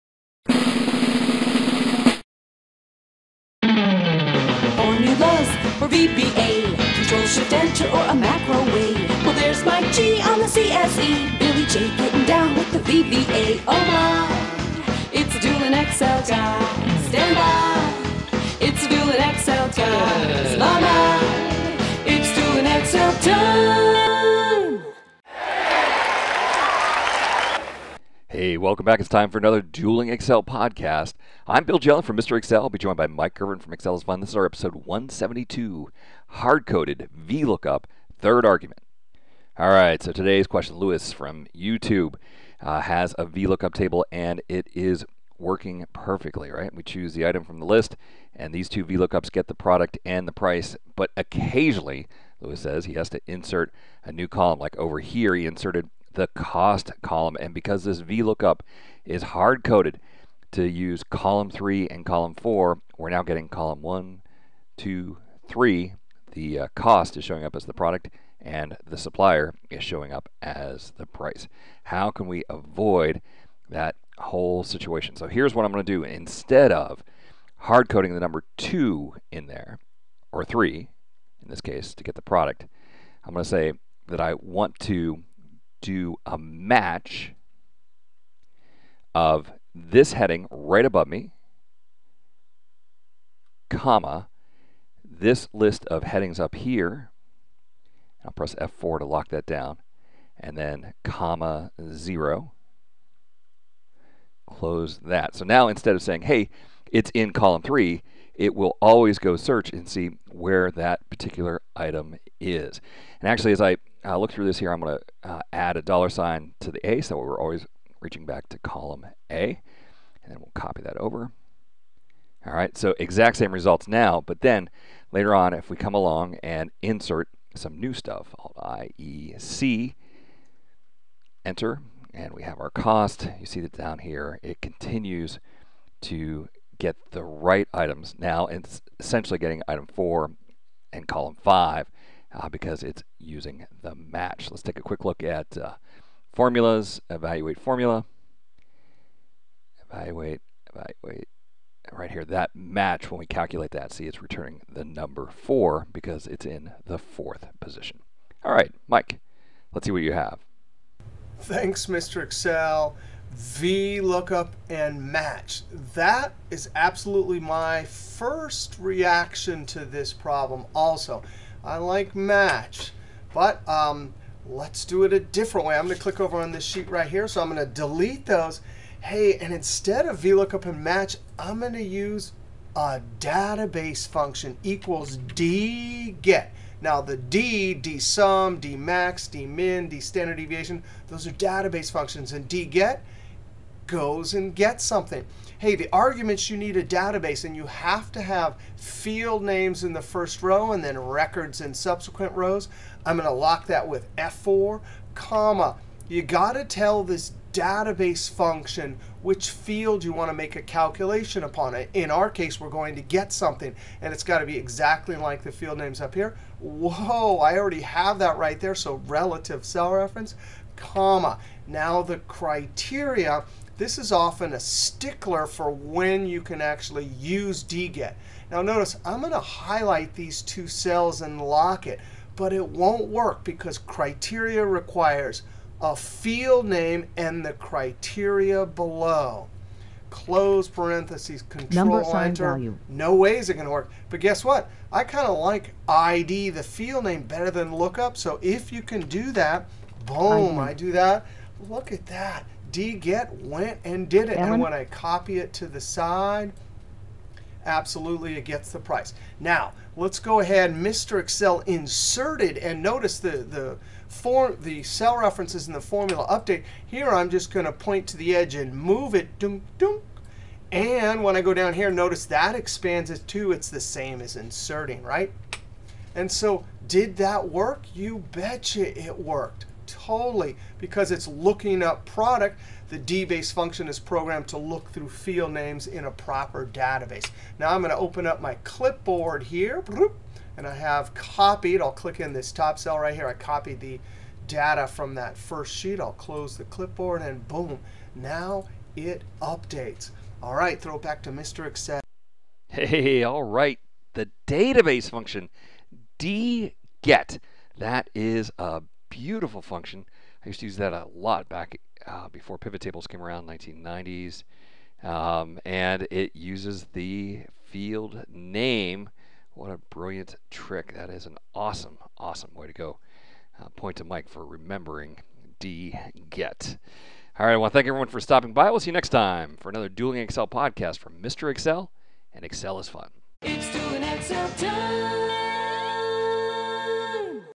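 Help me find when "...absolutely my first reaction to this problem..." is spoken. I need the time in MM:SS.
02:46.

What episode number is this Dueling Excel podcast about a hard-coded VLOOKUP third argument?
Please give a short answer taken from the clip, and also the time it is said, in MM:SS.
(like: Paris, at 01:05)
172, at 00:34.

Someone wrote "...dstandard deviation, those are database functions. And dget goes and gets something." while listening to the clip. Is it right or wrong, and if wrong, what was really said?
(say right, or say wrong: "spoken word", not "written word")
right.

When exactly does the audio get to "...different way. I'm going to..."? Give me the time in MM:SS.
02:55.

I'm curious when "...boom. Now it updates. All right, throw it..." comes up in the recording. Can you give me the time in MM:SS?
04:57.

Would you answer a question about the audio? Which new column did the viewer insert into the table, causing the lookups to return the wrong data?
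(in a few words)
cost column.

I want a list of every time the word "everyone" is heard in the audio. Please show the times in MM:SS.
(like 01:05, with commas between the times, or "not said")
05:27.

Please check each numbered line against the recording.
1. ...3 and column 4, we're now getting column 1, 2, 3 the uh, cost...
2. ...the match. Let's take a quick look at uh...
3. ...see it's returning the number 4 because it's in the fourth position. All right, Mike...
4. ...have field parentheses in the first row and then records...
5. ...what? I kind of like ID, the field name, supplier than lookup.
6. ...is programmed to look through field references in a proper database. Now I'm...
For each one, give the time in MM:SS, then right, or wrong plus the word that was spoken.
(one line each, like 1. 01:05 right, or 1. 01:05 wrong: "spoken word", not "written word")
1. 01:01 right
2. 02:23 right
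3. 02:33 right
4. 03:18 wrong: "names", not "parentheses"
5. 04:04 wrong: "better", not "supplier"
6. 04:43 wrong: "names", not "references".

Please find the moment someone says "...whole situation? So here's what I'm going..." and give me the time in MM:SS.
01:14.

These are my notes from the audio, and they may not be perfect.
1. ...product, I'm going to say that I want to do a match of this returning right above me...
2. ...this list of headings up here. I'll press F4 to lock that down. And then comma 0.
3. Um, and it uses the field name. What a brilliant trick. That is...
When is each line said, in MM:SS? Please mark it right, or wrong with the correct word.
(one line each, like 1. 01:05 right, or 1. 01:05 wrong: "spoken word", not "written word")
1. 01:22 wrong: "heading", not "returning"
2. 01:35 right
3. 05:15 right.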